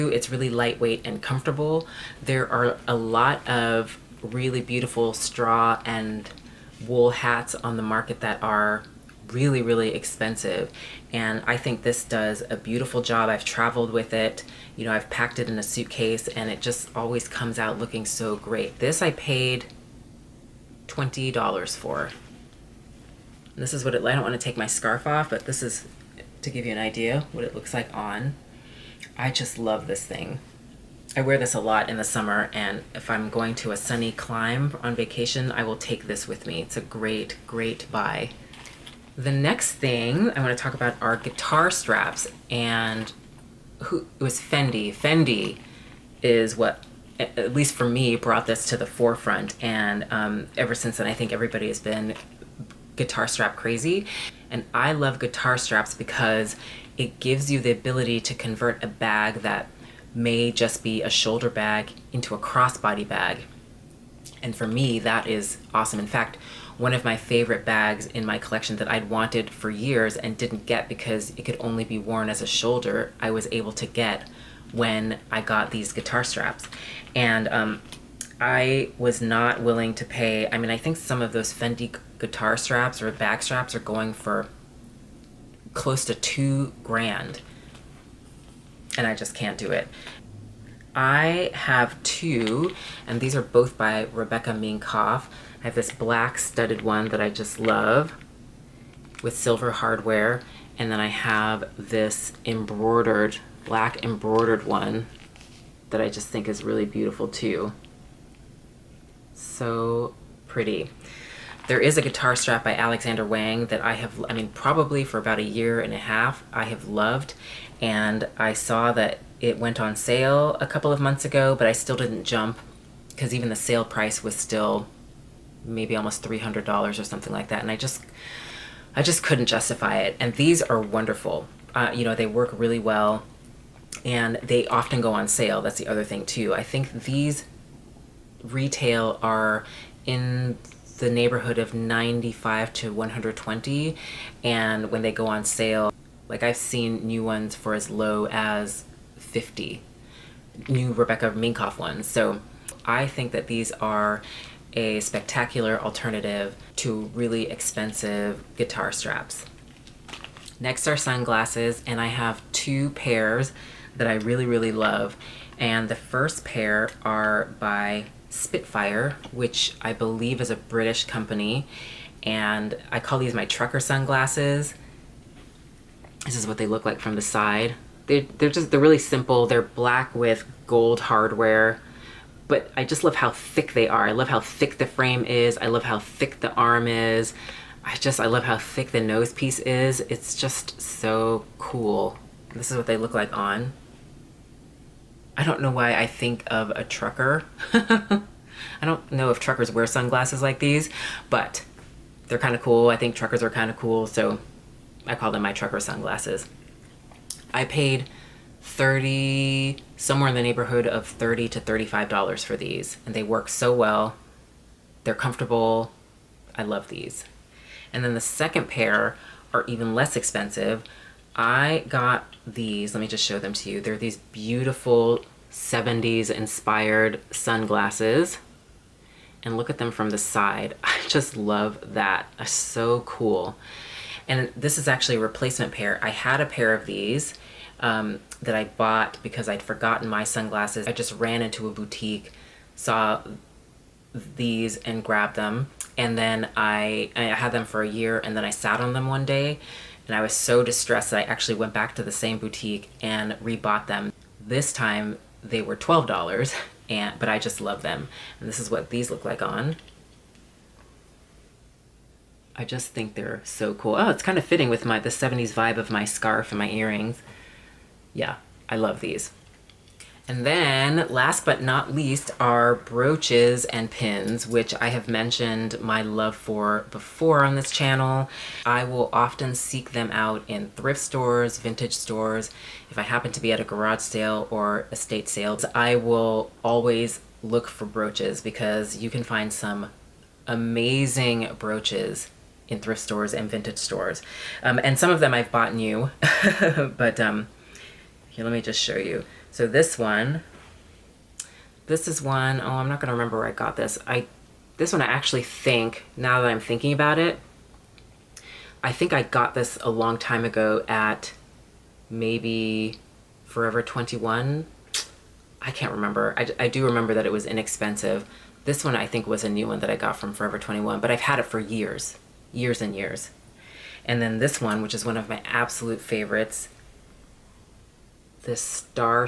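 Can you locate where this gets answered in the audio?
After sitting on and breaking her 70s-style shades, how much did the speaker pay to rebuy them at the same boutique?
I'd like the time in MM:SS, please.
04:15.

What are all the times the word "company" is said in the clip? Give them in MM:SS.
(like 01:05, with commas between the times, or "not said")
02:51.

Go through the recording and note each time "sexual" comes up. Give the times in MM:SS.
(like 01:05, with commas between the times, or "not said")
not said.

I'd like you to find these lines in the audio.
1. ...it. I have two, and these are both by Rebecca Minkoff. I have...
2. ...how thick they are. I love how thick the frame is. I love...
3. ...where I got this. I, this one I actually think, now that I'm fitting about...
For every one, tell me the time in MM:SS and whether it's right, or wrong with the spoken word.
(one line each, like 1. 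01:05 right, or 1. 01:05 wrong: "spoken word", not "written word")
1. 01:29 right
2. 03:03 right
3. 05:03 wrong: "thinking", not "fitting".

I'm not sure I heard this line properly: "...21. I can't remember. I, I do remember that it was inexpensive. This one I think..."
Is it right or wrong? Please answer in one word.
right.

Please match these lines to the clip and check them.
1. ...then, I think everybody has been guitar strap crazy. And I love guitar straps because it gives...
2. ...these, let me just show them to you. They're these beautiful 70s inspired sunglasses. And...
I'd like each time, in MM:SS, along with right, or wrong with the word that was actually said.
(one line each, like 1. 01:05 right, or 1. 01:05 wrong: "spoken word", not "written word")
1. 00:50 right
2. 03:42 right.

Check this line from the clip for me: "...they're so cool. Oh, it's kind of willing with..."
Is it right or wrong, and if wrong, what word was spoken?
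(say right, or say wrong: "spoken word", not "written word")
wrong: "fitting", not "willing".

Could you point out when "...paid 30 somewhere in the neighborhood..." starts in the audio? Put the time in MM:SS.
03:27.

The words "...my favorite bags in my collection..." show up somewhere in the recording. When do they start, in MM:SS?
01:07.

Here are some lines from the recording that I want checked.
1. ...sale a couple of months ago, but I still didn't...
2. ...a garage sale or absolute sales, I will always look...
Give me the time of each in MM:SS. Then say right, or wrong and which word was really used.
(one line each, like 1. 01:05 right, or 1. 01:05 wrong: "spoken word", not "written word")
1. 01:59 right
2. 04:43 wrong: "estate", not "absolute".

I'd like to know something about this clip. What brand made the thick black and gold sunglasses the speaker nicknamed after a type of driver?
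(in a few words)
Spitfire.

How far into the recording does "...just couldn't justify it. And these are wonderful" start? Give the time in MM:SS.
02:09.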